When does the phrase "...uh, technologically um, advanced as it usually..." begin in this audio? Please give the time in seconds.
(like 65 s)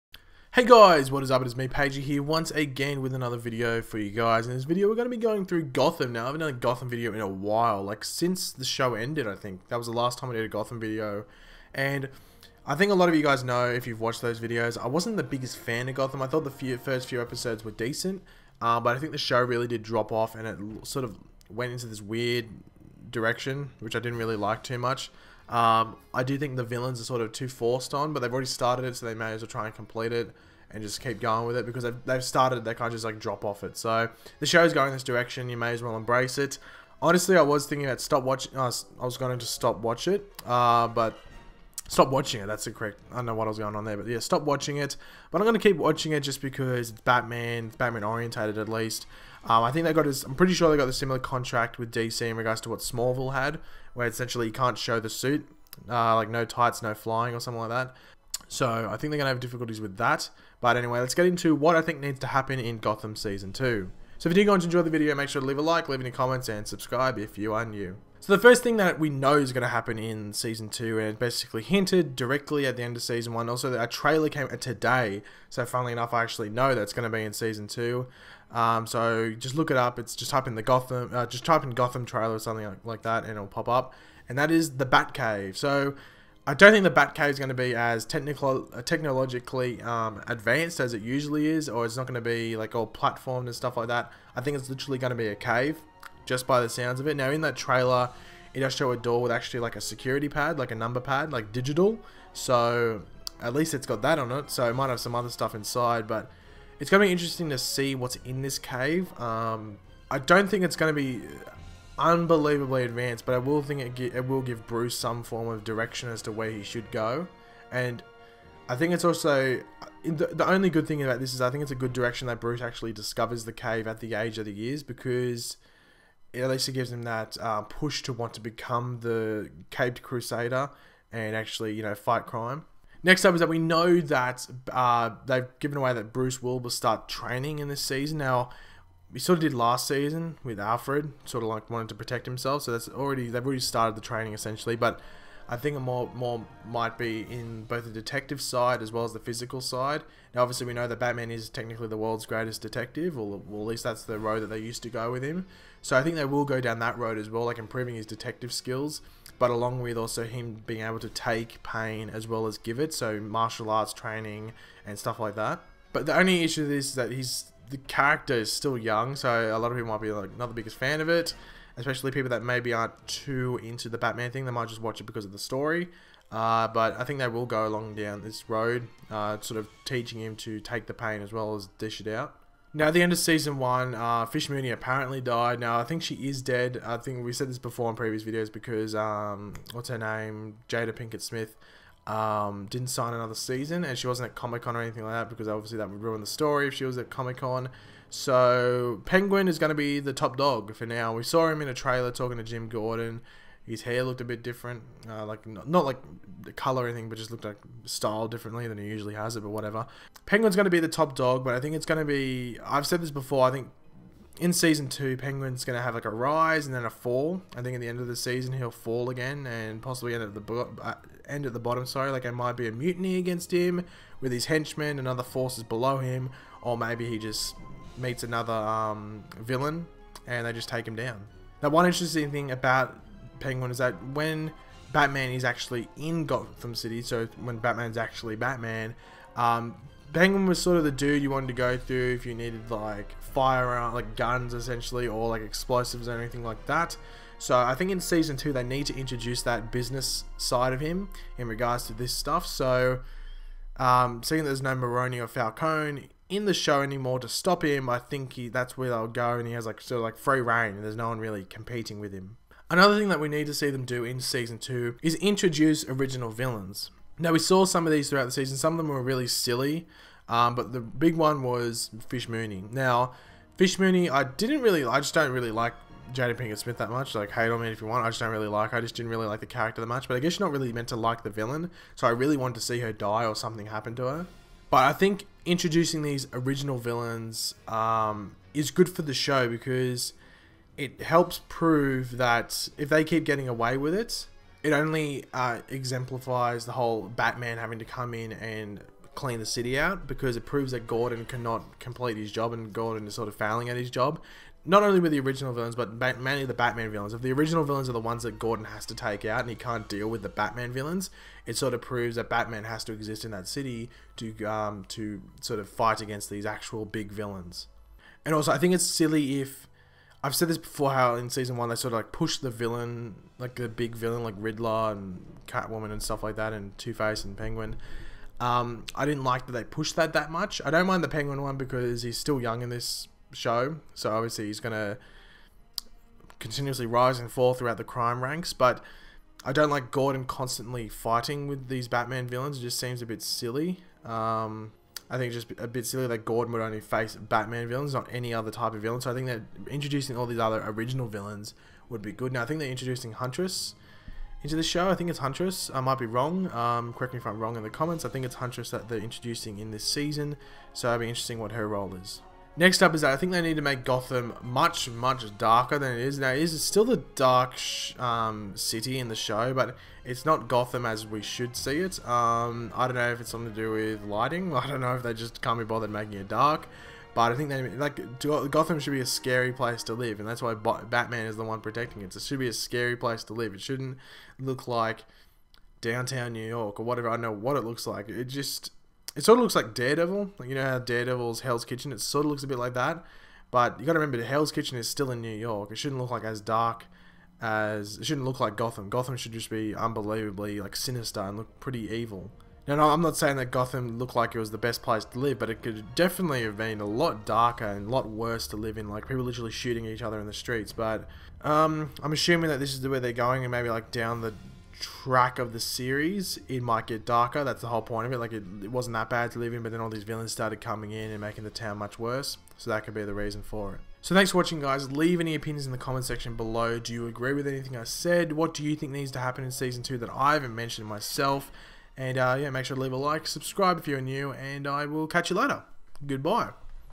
88 s.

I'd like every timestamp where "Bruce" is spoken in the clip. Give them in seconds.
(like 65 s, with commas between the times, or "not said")
114 s, 122 s, 136 s.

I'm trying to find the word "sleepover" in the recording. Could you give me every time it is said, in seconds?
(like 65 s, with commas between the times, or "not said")
not said.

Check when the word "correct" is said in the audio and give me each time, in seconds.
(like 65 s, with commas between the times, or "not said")
42 s, 356 s.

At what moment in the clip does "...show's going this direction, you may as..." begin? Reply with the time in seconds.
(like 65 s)
34 s.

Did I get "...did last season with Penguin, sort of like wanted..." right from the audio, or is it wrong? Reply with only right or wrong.
wrong.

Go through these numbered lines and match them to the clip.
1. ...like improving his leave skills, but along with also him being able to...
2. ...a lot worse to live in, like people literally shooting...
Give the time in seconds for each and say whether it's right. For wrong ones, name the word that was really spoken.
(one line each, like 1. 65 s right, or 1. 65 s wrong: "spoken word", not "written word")
1. 157 s wrong: "detective", not "leave"
2. 407 s right.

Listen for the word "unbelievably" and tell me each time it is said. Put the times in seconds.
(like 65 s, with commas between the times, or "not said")
111 s, 399 s.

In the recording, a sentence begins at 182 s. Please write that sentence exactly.
Now, at the end of season one, uh, Fish Mooney apparently died.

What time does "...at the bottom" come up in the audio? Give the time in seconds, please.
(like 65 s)
221 s.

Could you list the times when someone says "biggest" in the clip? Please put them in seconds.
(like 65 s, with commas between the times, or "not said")
15 s, 170 s.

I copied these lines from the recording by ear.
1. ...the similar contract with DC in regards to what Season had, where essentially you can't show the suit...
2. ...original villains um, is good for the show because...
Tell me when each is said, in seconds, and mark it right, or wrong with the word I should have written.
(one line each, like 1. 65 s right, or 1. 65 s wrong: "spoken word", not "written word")
1. 50 s wrong: "Smallville", not "Season"
2. 286 s right.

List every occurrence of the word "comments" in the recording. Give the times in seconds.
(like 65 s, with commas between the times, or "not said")
66 s, 357 s, 425 s.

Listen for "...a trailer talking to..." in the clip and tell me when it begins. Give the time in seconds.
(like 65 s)
201 s.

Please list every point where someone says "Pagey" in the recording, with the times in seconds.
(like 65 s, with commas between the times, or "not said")
1 s.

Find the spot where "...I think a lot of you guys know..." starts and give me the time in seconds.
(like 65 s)
12 s.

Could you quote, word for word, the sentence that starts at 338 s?
But I don't like Gordon constantly fighting with these Batman villains.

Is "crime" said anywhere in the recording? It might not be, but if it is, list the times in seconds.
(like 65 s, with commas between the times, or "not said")
132 s, 337 s.